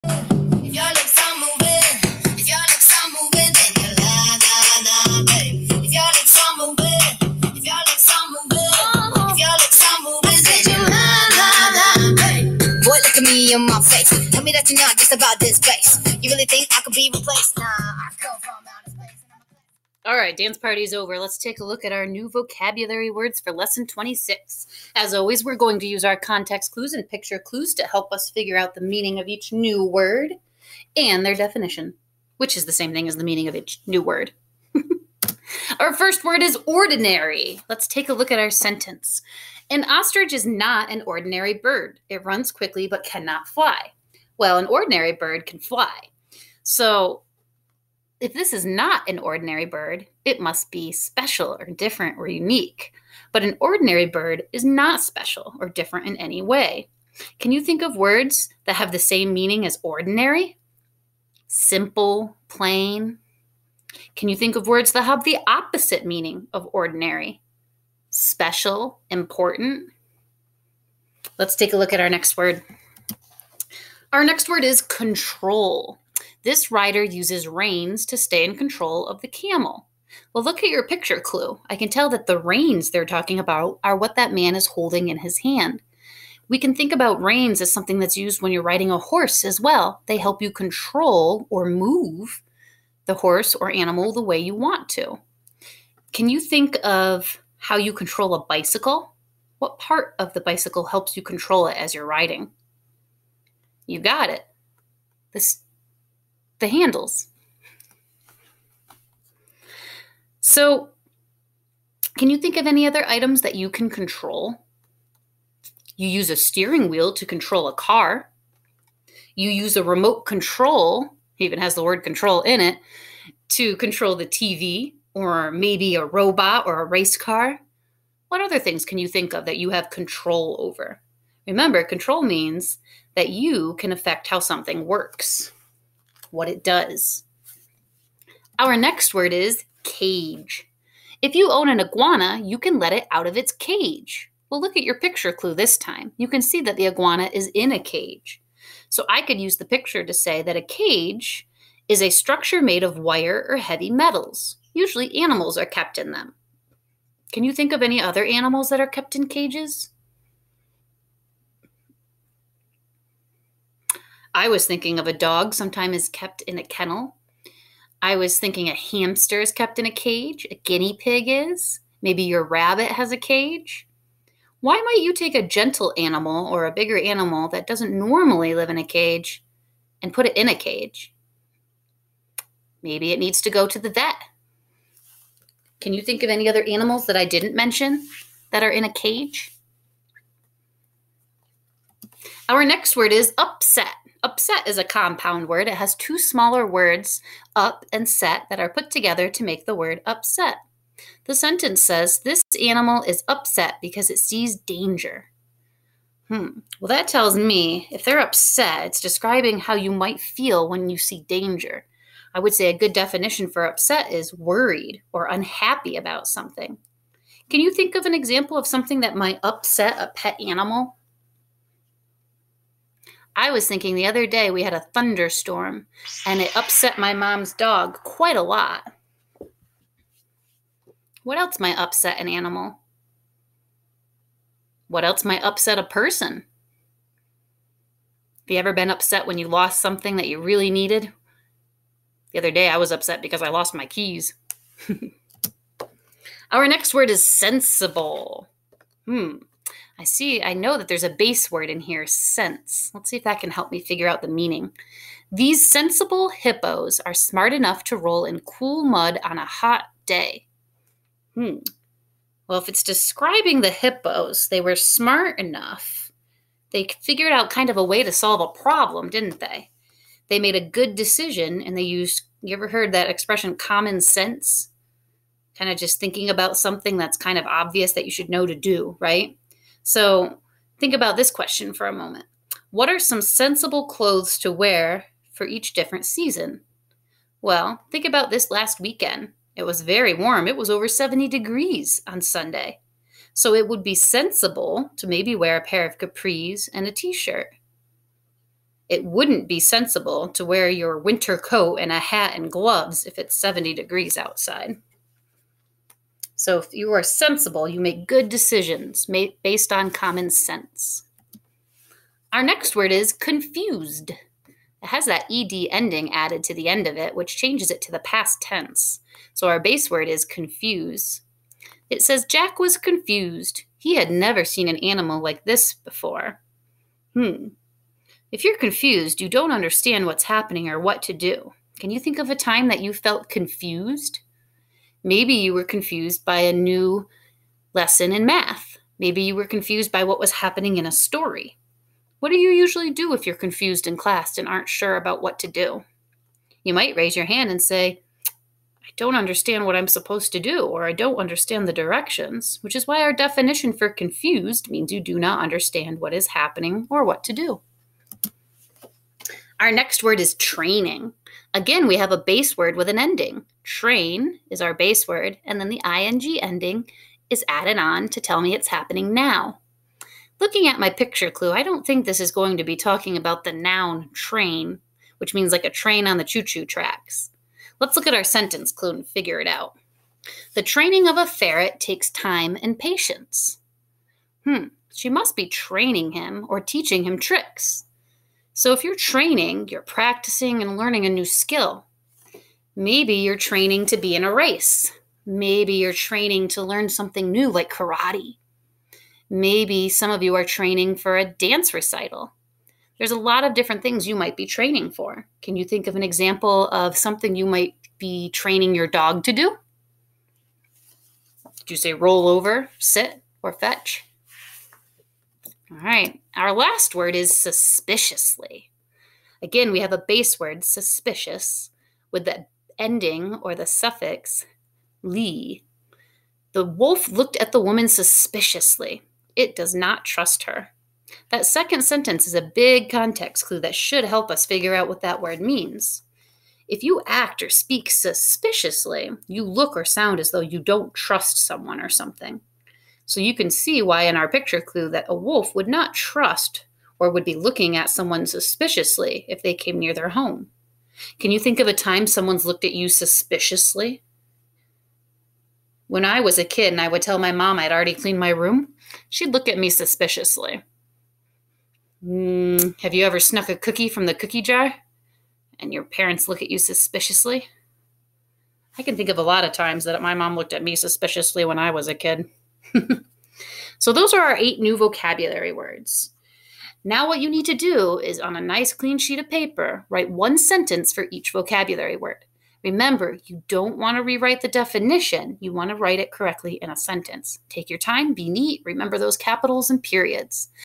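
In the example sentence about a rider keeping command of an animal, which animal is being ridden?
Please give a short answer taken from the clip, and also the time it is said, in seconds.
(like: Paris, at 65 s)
Camel, at 79 s.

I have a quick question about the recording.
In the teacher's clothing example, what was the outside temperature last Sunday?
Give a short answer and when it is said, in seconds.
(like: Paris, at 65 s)
Over 70 degrees, at 290 s.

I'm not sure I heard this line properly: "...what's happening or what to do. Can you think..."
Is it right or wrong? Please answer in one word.
right.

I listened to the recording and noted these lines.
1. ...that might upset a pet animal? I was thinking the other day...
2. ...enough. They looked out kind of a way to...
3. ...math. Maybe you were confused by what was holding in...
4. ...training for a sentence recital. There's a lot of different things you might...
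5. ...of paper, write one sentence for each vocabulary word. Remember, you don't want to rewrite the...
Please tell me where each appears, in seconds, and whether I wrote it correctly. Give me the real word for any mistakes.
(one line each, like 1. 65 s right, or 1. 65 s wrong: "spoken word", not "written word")
1. 219 s right
2. 265 s wrong: "figured", not "looked"
3. 338 s wrong: "happening", not "holding"
4. 400 s wrong: "dance", not "sentence"
5. 479 s right.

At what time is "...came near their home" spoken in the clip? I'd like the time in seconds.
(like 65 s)
449 s.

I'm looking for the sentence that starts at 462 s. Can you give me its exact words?
Mm, have you ever snuck a cookie from the cookie jar?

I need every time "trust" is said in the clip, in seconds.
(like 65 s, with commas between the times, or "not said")
430 s, 440 s, 445 s.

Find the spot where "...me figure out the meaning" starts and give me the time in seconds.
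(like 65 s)
253 s.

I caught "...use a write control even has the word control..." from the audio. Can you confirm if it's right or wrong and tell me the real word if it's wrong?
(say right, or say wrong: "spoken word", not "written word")
wrong: "remote", not "write".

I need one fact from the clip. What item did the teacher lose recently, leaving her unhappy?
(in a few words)
Keys.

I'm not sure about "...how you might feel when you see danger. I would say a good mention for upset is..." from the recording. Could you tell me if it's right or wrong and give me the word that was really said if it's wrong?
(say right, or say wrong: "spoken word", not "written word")
wrong: "definition", not "mention".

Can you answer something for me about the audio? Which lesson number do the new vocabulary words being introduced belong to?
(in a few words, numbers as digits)
26.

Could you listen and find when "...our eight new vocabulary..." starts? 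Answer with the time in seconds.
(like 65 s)
474 s.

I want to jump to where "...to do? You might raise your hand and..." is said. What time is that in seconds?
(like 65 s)
345 s.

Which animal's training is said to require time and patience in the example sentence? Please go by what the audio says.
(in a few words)
Ferret.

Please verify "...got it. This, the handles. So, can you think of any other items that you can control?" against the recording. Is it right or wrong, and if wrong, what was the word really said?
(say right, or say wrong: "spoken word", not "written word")
right.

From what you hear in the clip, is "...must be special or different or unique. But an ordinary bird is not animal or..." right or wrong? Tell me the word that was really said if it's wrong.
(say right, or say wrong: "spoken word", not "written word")
wrong: "special", not "animal".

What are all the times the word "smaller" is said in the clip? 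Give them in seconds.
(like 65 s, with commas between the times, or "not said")
196 s.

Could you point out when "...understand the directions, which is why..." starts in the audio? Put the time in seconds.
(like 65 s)
351 s.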